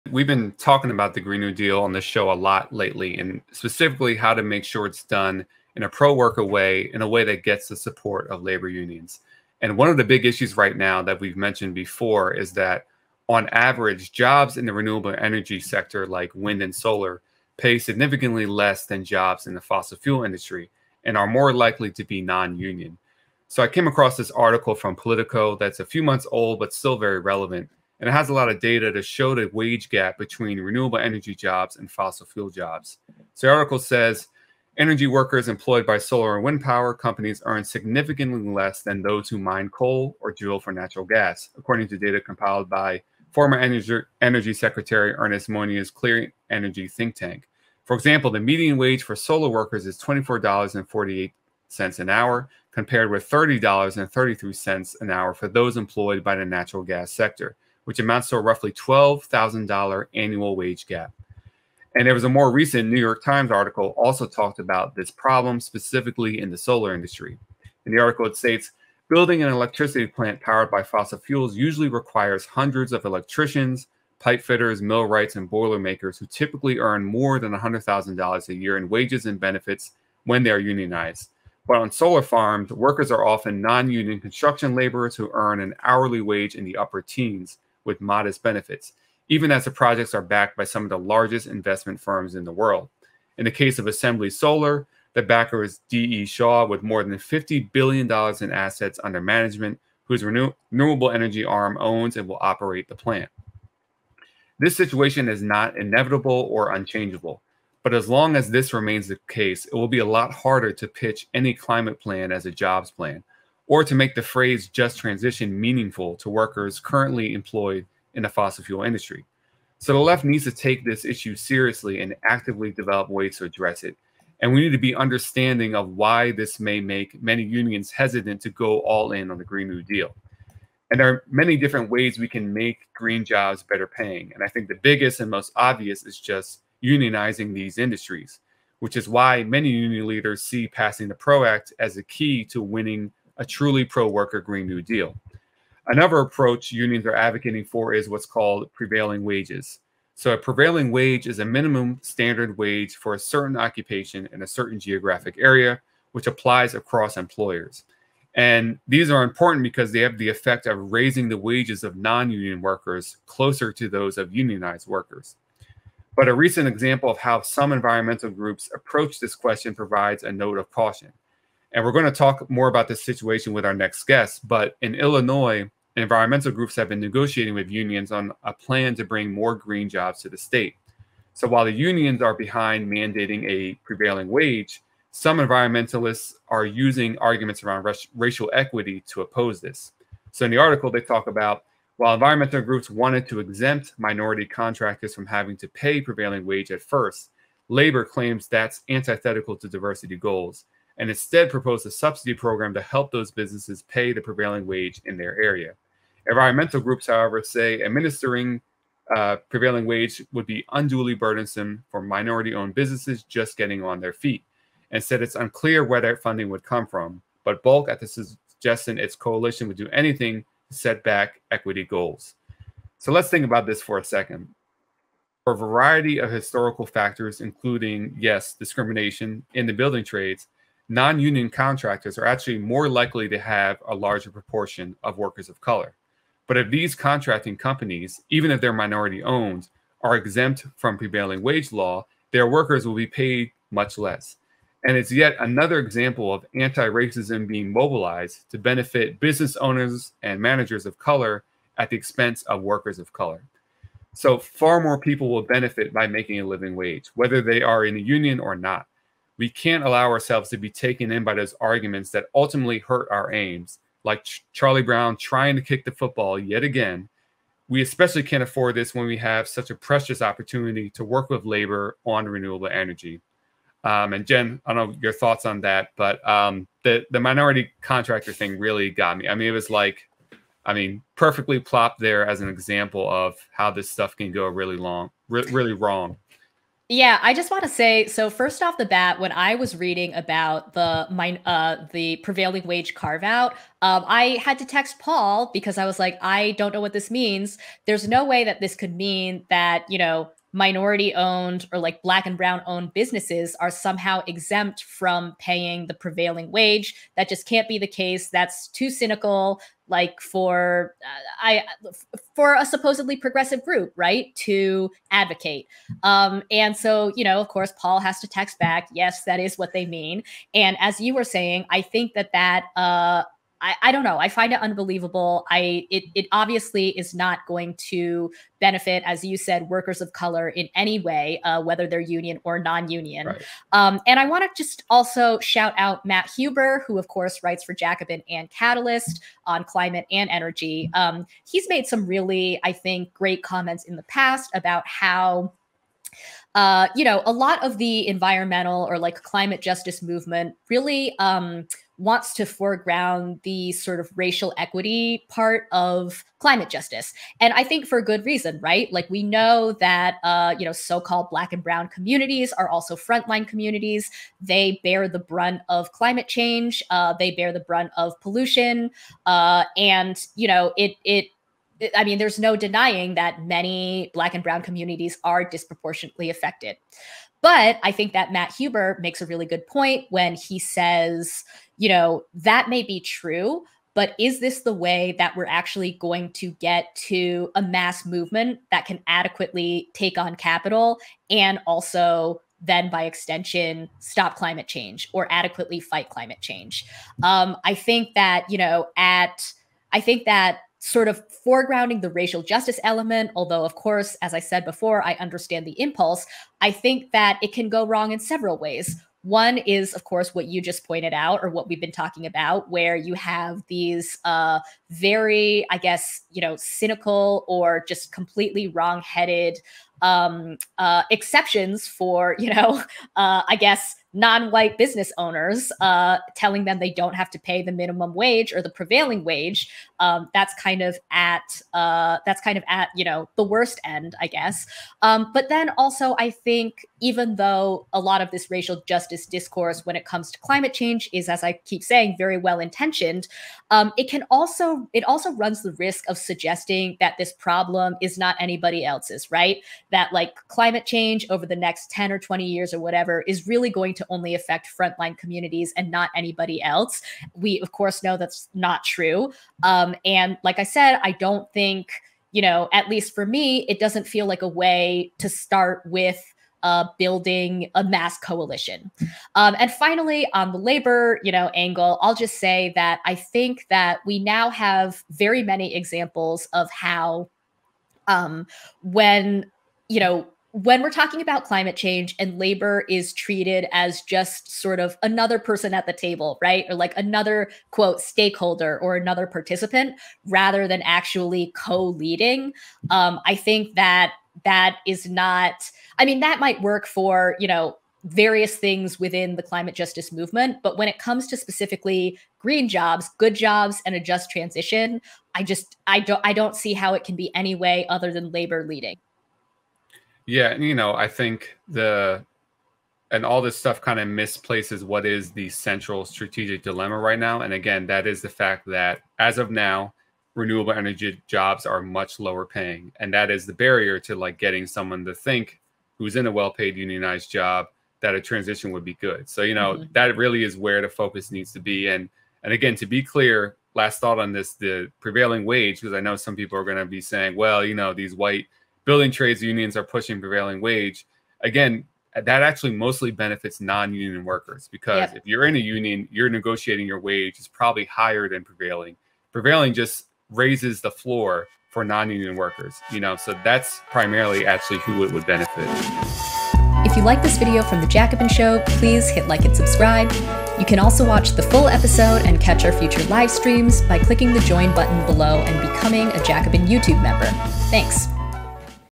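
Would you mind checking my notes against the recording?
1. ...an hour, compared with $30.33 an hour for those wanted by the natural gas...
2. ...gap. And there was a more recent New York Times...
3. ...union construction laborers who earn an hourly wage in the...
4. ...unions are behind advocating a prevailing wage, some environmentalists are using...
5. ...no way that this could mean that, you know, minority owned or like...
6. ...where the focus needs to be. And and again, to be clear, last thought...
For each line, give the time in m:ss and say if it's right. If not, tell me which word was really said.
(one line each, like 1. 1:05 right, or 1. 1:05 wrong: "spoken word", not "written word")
1. 0:51 wrong: "employed", not "wanted"
2. 1:00 right
3. 1:23 right
4. 3:01 wrong: "mandating", not "advocating"
5. 4:58 right
6. 8:50 right.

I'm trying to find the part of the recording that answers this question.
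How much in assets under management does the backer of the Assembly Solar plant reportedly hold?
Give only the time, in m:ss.
1:37.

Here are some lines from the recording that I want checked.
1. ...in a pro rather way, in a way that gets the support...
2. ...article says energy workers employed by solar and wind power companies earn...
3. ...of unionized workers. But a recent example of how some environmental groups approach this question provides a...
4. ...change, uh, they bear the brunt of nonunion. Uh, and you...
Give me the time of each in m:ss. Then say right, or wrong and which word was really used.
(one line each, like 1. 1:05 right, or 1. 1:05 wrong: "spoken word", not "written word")
1. 0:05 wrong: "worker", not "rather"
2. 0:33 right
3. 2:44 right
4. 6:06 wrong: "pollution", not "nonunion".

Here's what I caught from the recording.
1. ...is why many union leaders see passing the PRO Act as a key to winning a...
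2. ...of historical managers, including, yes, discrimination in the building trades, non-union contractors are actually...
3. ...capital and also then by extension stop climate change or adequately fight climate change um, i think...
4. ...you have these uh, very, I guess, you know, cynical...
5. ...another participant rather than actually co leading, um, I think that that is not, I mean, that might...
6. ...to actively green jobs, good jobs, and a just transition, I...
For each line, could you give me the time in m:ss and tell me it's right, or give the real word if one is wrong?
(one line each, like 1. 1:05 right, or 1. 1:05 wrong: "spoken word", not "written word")
1. 2:18 right
2. 3:46 wrong: "factors", not "managers"
3. 6:30 right
4. 6:52 right
5. 8:08 right
6. 8:21 wrong: "specifically", not "actively".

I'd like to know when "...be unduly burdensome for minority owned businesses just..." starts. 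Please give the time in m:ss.
3:30.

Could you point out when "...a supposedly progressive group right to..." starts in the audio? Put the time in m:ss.
5:12.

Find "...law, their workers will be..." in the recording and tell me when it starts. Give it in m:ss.
4:01.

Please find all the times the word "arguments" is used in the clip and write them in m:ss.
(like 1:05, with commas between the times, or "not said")
3:07, 4:21.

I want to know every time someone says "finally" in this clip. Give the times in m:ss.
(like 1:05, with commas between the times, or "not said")
7:49.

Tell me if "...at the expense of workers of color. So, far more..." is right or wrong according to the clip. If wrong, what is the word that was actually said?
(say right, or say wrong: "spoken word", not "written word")
right.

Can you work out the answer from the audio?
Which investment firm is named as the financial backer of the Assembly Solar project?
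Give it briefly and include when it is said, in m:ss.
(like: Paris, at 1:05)
D.E. Shaw, at 1:35.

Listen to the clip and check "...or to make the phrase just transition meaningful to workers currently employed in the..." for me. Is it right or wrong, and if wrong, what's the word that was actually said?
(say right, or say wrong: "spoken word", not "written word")
right.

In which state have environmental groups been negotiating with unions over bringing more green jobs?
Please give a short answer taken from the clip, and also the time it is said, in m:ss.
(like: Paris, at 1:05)
Illinois, at 2:54.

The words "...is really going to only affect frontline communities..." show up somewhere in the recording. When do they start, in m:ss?
7:33.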